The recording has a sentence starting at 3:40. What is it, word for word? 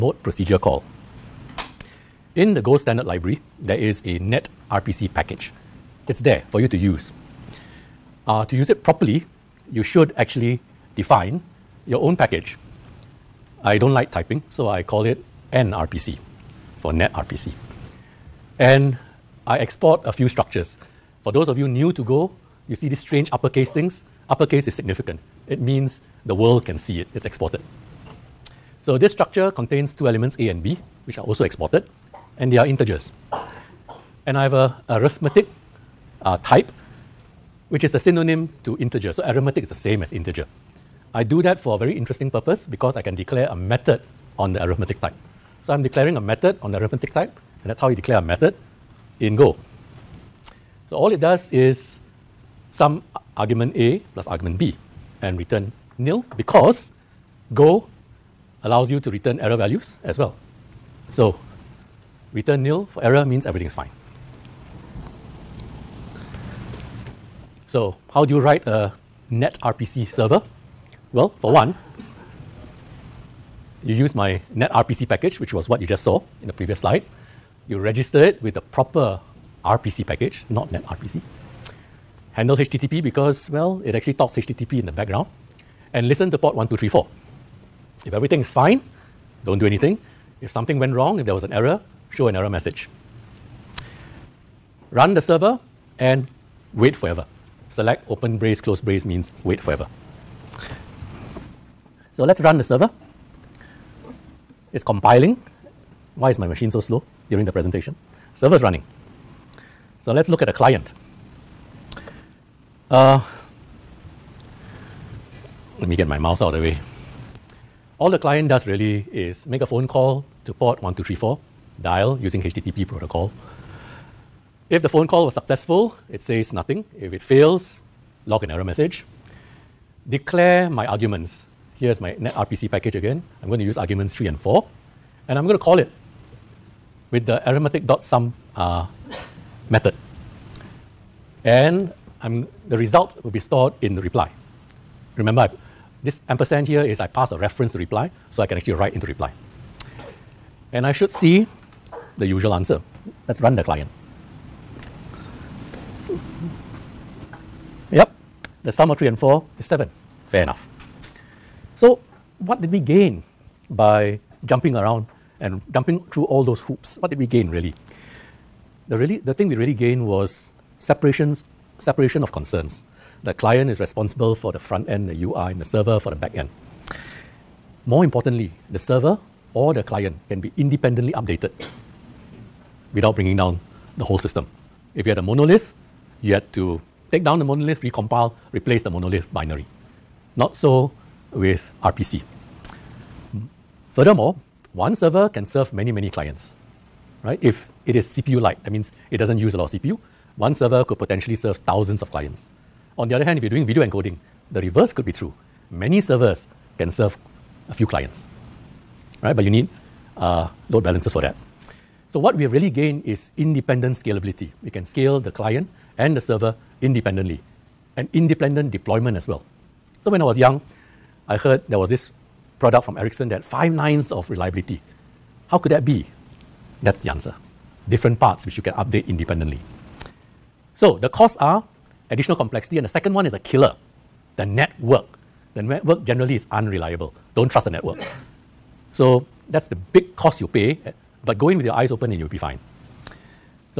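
So when I was young, I heard there was this product from Ericsson that five nines of reliability.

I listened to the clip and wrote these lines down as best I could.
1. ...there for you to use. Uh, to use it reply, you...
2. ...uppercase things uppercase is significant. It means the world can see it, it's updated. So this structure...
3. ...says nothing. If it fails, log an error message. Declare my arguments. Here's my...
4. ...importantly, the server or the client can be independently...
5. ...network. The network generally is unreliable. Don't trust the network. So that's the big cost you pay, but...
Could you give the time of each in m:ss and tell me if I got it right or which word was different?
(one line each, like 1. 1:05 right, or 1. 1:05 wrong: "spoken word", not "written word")
1. 0:06 wrong: "properly", not "reply"
2. 0:23 wrong: "exported", not "updated"
3. 2:06 right
4. 2:58 right
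5. 3:54 right.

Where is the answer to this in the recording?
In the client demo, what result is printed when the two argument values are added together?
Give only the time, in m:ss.
2:39.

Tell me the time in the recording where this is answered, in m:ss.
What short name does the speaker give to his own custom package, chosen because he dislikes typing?
0:15.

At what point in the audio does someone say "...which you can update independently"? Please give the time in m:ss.
3:48.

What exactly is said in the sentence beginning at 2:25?
Remember, I, this ampersand here is I pass a reference to reply, so I can actually write into reply.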